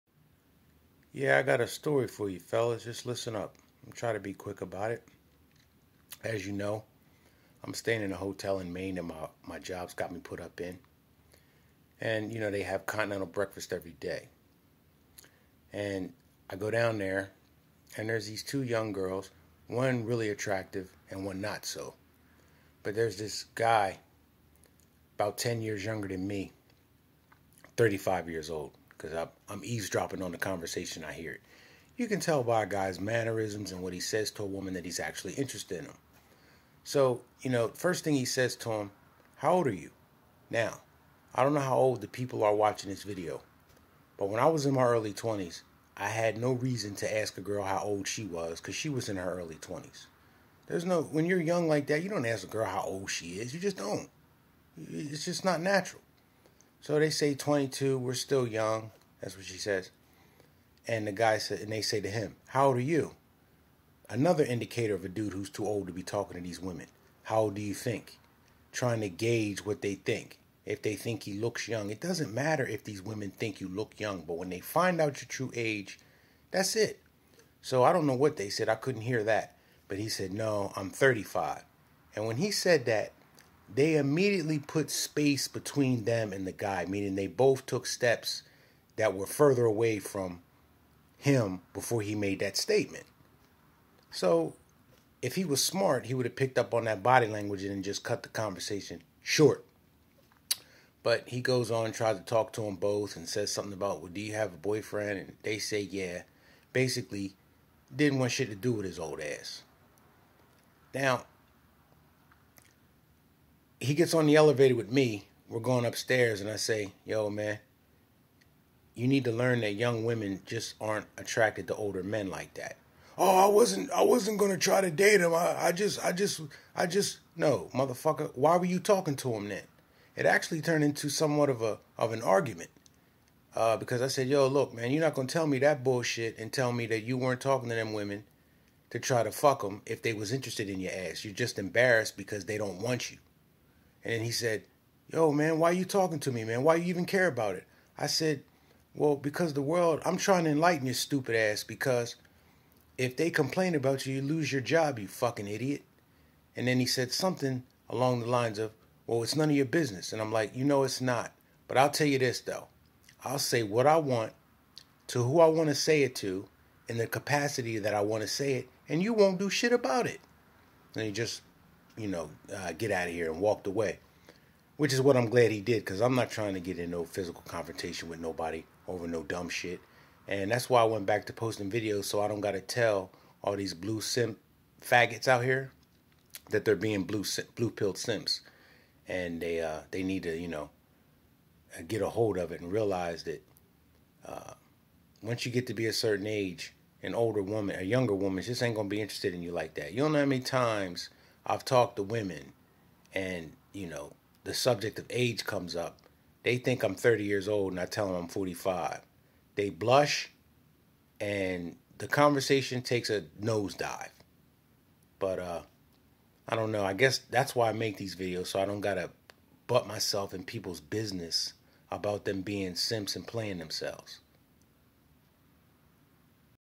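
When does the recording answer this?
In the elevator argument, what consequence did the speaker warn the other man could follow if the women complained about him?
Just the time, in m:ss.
2:34.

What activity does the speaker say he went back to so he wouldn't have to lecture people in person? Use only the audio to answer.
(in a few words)
Posting videos.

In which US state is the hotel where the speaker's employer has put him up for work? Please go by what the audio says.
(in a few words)
Maine.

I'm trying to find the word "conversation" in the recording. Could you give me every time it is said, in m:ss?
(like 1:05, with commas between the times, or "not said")
0:30, 1:38, 3:32.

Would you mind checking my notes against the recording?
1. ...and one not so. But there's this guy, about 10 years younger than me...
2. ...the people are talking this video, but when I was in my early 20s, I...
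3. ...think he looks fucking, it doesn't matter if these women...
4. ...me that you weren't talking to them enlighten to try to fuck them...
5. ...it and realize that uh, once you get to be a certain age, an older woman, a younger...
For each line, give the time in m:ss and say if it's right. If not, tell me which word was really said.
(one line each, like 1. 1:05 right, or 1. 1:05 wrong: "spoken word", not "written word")
1. 0:21 right
2. 0:42 wrong: "watching", not "talking"
3. 1:10 wrong: "young", not "fucking"
4. 2:16 wrong: "women", not "enlighten"
5. 3:12 right.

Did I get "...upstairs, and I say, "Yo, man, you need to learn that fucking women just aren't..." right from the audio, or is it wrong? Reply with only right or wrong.
wrong.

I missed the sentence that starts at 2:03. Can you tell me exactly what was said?
I wasn't gonna try to date him.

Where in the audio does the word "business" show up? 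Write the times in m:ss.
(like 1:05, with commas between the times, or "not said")
2:39, 3:40.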